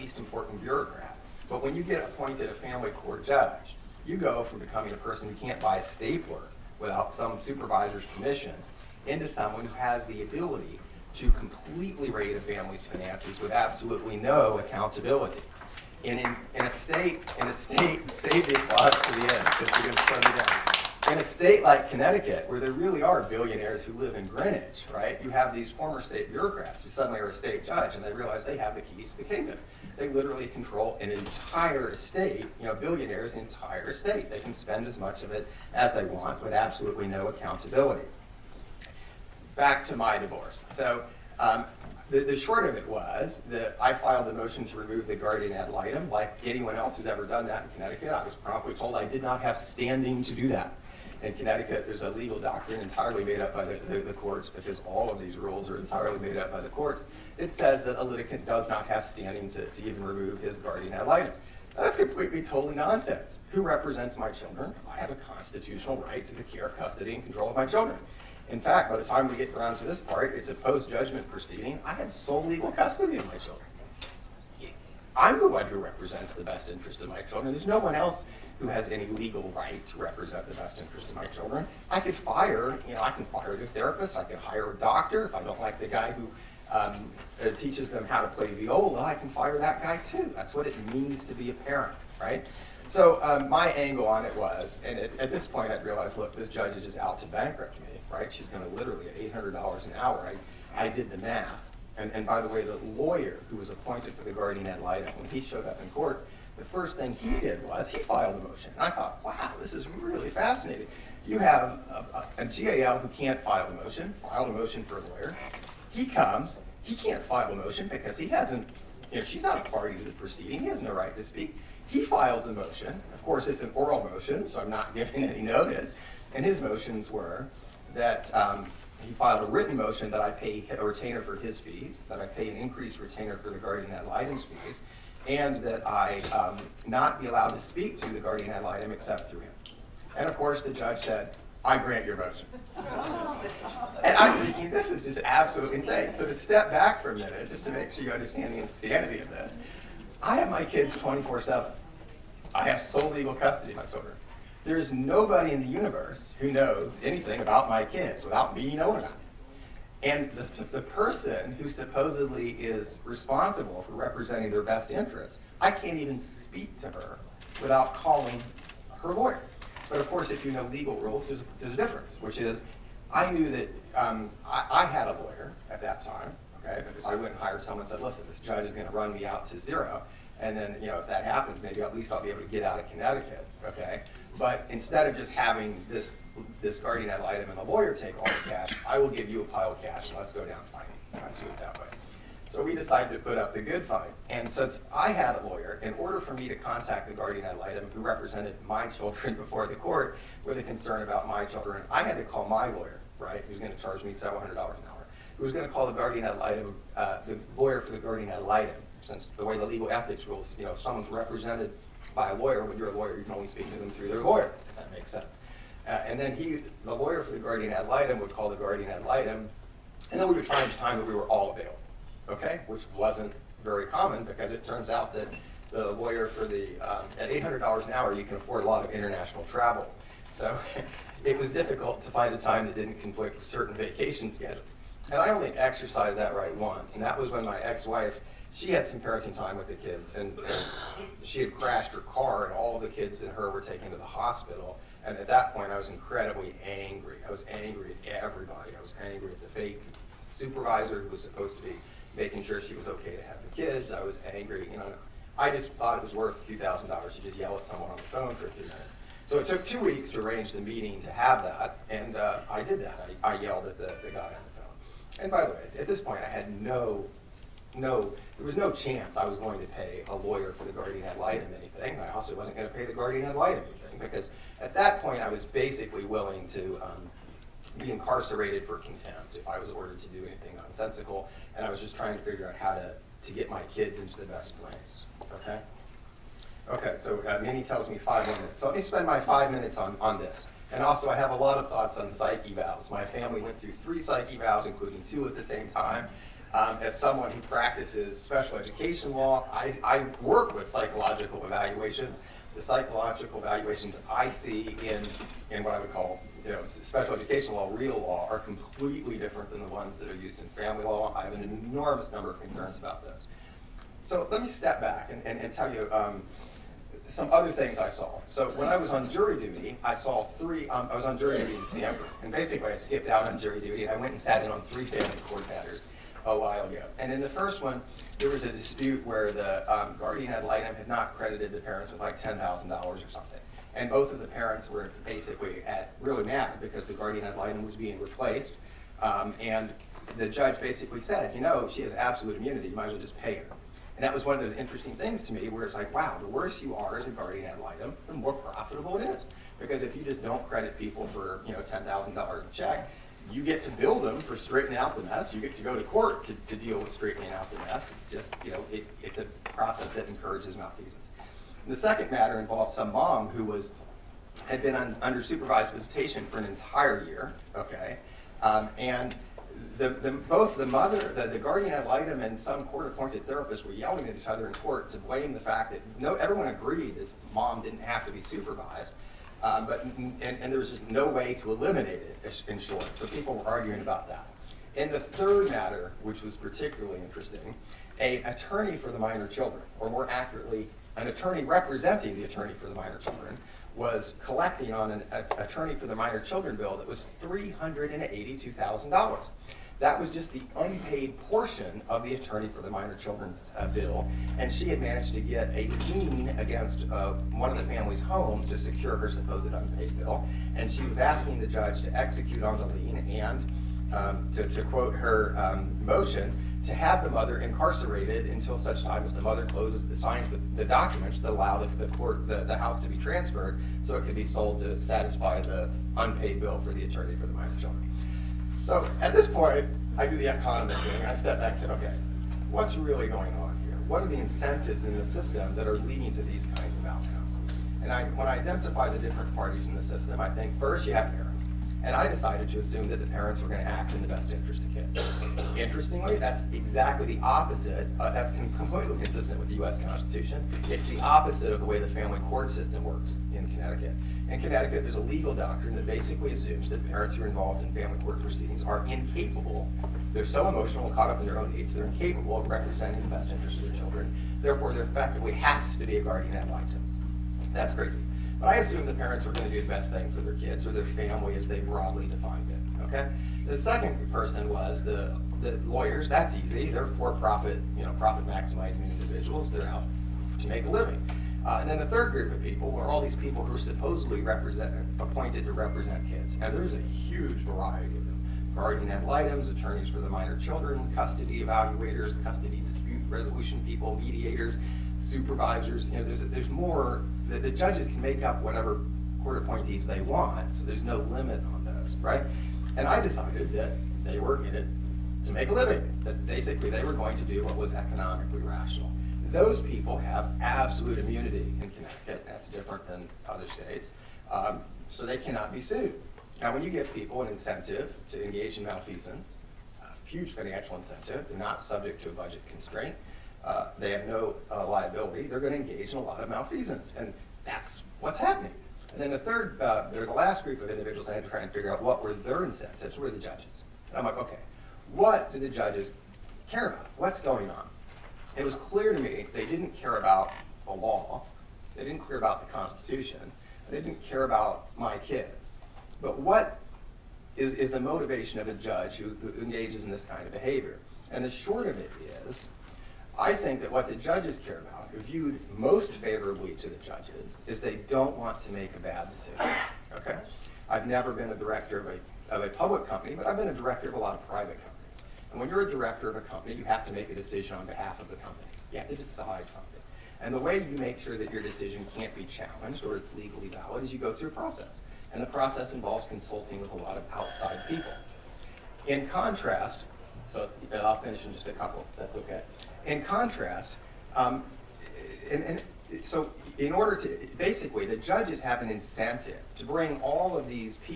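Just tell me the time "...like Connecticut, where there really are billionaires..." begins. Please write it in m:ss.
0:21.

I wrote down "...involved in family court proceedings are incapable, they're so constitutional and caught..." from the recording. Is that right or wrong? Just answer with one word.
wrong.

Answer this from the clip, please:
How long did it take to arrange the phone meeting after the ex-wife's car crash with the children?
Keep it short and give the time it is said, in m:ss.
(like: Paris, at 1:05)
Two weeks, at 4:19.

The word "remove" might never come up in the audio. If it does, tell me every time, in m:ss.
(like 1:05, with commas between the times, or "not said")
0:44, 1:00.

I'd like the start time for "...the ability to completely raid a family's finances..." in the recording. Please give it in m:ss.
0:10.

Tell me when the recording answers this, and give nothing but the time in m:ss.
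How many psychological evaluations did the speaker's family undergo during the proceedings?
4:53.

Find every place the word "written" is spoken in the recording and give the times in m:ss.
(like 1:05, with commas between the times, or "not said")
2:09.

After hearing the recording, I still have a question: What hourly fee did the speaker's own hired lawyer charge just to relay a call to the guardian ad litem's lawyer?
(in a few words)
$700.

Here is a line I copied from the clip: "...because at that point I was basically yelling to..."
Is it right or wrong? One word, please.
wrong.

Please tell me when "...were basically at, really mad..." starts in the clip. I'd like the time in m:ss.
5:34.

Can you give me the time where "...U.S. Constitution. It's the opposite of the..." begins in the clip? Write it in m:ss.
7:29.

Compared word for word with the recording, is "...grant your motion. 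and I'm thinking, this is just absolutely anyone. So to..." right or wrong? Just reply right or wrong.
wrong.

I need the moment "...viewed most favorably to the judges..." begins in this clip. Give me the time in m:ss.
9:14.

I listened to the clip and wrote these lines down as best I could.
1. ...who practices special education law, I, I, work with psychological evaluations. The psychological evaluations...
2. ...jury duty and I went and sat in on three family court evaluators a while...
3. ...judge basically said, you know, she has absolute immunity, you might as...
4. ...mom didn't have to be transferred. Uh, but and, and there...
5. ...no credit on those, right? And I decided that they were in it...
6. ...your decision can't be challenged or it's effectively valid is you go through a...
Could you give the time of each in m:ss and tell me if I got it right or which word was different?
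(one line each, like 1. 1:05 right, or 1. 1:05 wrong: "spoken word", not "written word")
1. 4:57 right
2. 5:23 wrong: "matters", not "evaluators"
3. 5:40 right
4. 6:17 wrong: "supervised", not "transferred"
5. 8:20 wrong: "limit", not "credit"
6. 9:31 wrong: "legally", not "effectively".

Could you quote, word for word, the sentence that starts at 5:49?
Because if you just don't credit people for, you know, $10,000 check, you get to bill them for straightening out the mess.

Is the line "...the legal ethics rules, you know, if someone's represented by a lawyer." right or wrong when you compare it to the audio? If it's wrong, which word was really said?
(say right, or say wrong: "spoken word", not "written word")
right.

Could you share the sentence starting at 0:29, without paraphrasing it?
They literally control an entire state, you know, billionaires' entire state.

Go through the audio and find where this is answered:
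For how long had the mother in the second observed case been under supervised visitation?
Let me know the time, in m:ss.
6:06.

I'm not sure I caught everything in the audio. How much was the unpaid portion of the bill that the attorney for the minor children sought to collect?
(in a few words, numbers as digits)
$382,000.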